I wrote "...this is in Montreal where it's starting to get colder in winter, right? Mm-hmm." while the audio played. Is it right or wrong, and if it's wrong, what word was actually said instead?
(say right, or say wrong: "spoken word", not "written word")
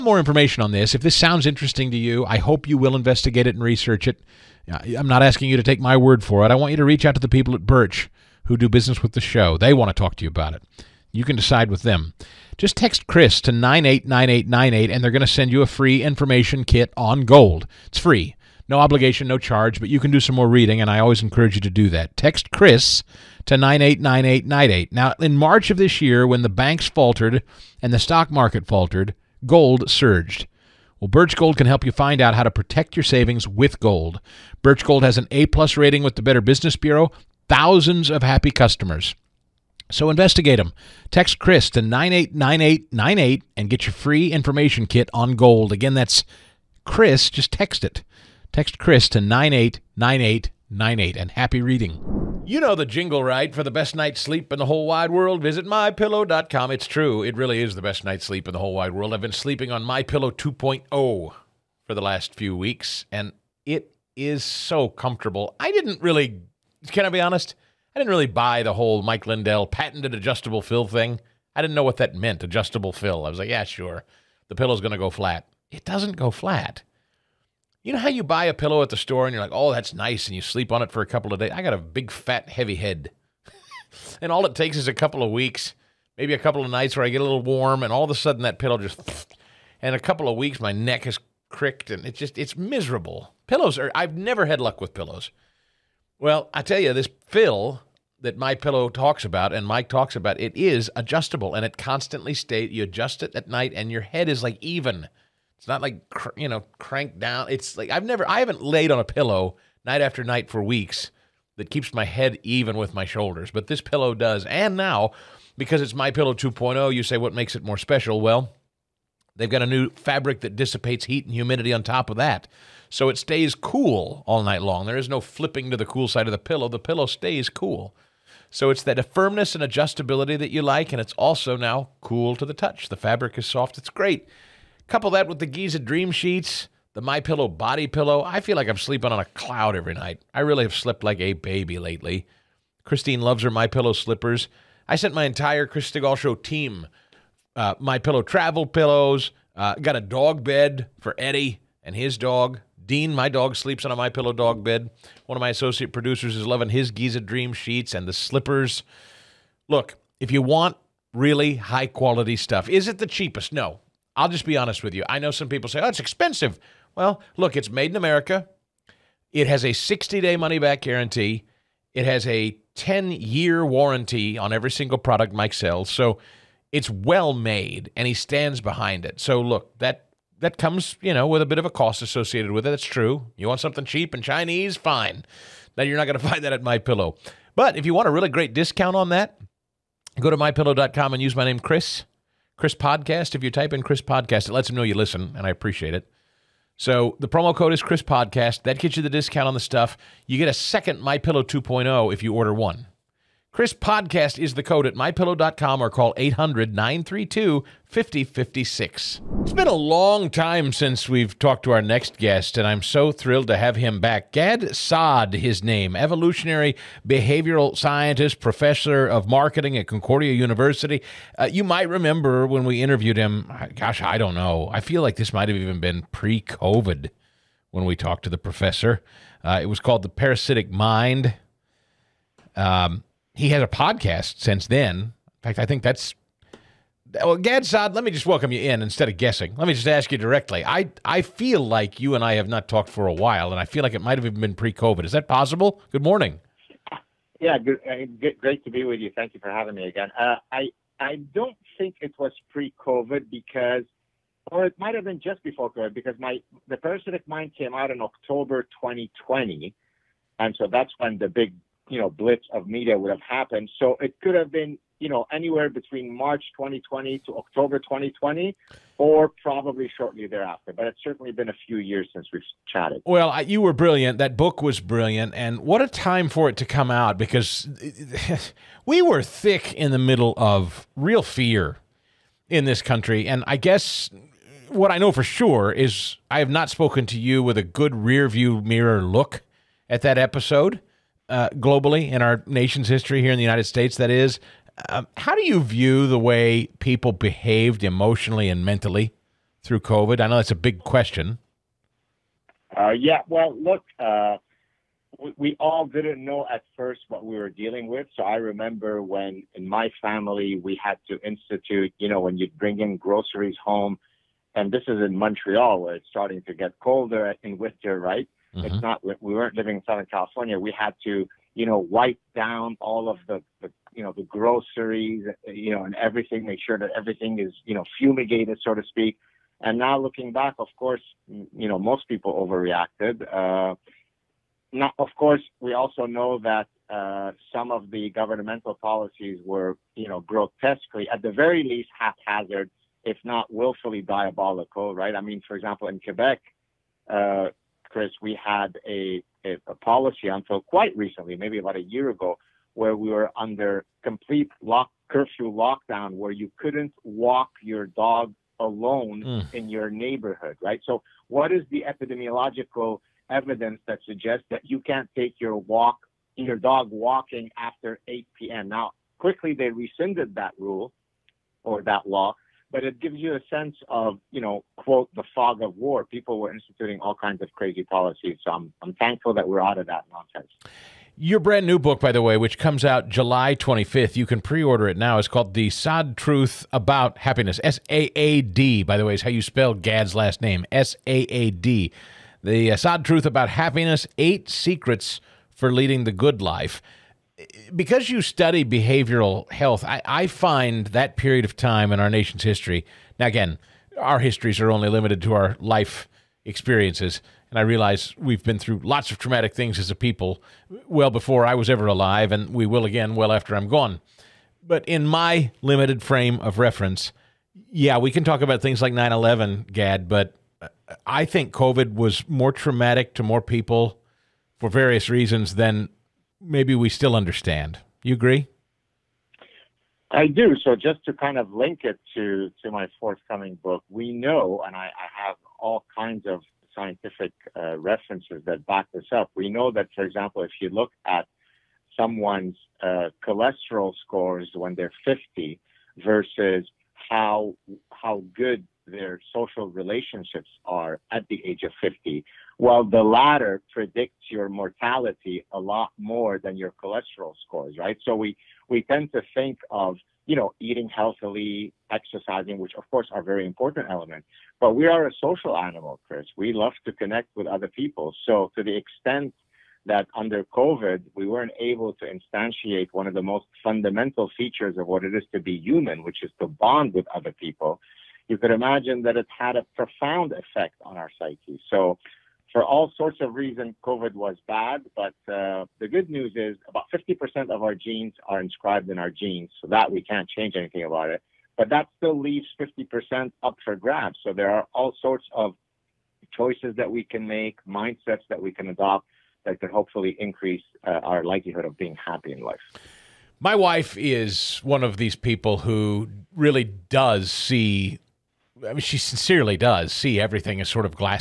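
right.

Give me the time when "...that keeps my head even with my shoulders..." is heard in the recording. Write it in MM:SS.
01:51.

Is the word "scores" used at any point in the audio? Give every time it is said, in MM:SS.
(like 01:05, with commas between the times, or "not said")
07:24, 07:37.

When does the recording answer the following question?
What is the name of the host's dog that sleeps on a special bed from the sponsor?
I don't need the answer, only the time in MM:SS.
02:32.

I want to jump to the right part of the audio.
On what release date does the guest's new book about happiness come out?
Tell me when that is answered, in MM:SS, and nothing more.
06:23.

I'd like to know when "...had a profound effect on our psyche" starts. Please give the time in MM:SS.
07:59.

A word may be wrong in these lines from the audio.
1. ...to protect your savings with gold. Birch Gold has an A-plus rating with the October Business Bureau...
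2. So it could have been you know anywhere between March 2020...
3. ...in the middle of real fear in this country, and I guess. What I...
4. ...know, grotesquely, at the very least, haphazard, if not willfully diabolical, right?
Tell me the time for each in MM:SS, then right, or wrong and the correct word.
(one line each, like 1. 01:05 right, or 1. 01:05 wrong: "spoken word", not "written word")
1. 00:32 wrong: "Better", not "October"
2. 04:23 right
3. 04:39 right
4. 05:40 right.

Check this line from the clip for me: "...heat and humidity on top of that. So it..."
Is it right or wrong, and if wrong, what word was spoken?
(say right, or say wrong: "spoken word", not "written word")
right.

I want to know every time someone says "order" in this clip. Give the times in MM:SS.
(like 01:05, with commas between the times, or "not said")
03:22, 06:24.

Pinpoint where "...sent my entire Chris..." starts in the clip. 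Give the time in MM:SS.
02:24.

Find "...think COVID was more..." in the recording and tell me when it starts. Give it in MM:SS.
07:01.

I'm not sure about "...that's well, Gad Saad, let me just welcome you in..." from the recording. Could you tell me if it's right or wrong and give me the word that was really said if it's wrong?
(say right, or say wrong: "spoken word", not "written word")
right.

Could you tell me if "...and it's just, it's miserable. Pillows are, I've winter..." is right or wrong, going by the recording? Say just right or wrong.
wrong.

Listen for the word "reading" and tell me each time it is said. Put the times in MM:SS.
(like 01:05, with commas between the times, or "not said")
00:20, 00:51.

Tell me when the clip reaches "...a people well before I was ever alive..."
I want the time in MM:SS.
06:49.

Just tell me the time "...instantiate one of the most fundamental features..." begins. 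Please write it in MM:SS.
07:52.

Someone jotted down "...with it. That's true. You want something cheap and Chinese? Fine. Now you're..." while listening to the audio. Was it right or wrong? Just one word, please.
right.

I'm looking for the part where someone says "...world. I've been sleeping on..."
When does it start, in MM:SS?
00:58.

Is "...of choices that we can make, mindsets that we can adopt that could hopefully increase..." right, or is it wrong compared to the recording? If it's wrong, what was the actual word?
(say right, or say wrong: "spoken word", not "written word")
right.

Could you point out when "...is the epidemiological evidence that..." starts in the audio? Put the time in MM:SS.
06:01.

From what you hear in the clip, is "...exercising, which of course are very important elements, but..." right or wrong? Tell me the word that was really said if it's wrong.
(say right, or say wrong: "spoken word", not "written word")
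right.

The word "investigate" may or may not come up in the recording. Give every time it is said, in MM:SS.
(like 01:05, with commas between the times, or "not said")
00:02, 00:40.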